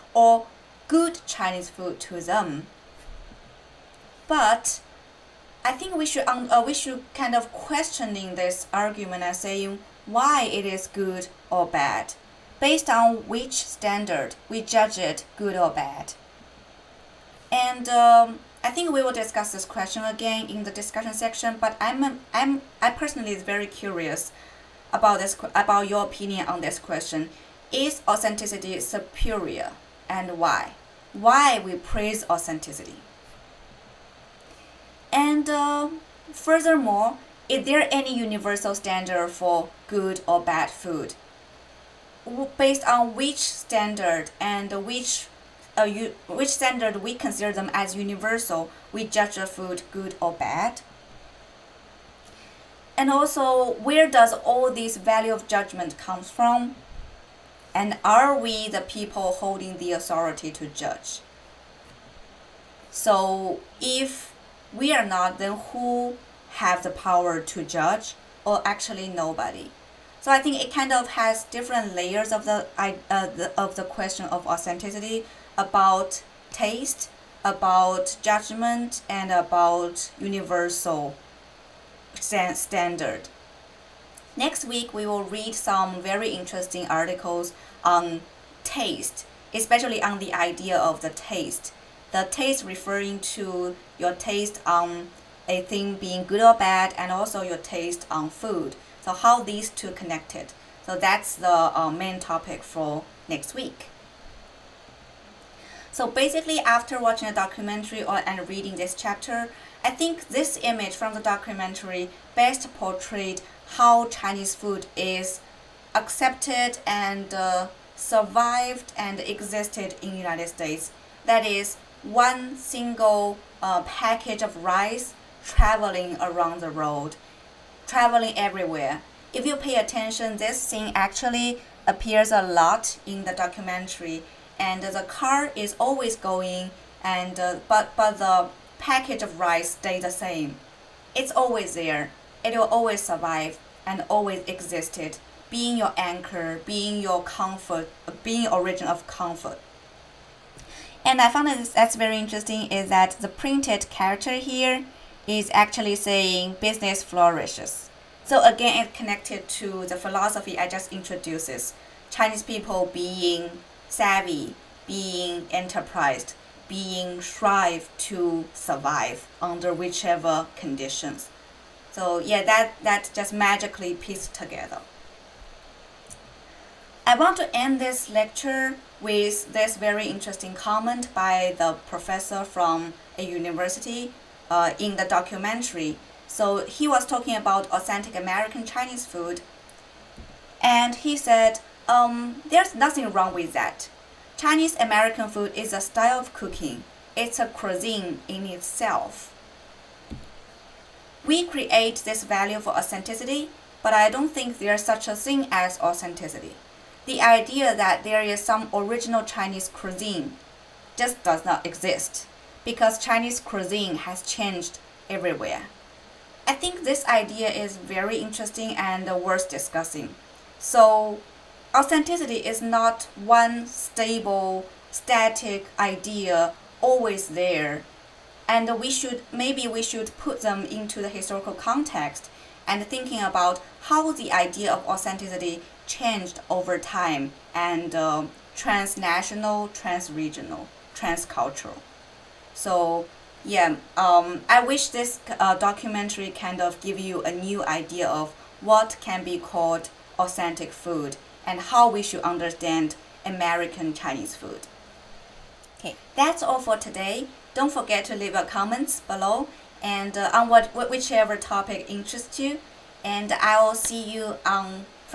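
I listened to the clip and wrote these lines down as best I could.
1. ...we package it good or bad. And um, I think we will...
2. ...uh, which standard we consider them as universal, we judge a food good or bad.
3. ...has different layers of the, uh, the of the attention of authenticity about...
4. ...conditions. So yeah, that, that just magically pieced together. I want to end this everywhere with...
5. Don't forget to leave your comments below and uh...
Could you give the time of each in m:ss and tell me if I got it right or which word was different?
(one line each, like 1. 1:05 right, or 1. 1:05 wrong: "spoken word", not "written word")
1. 0:14 wrong: "judge", not "package"
2. 0:45 right
3. 1:11 wrong: "question", not "attention"
4. 2:50 wrong: "lecture", not "everywhere"
5. 4:17 right.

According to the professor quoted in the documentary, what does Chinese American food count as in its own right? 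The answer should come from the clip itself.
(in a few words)
a cuisine.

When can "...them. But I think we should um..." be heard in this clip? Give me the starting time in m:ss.
0:02.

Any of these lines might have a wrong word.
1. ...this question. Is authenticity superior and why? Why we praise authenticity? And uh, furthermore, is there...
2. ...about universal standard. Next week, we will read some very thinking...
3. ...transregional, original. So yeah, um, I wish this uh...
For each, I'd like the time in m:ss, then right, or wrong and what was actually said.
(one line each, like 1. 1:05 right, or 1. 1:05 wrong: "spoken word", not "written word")
1. 0:26 right
2. 1:19 wrong: "interesting", not "thinking"
3. 3:59 wrong: "transcultural", not "original".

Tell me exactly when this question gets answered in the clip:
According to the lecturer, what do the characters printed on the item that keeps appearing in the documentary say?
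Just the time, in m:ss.
2:36.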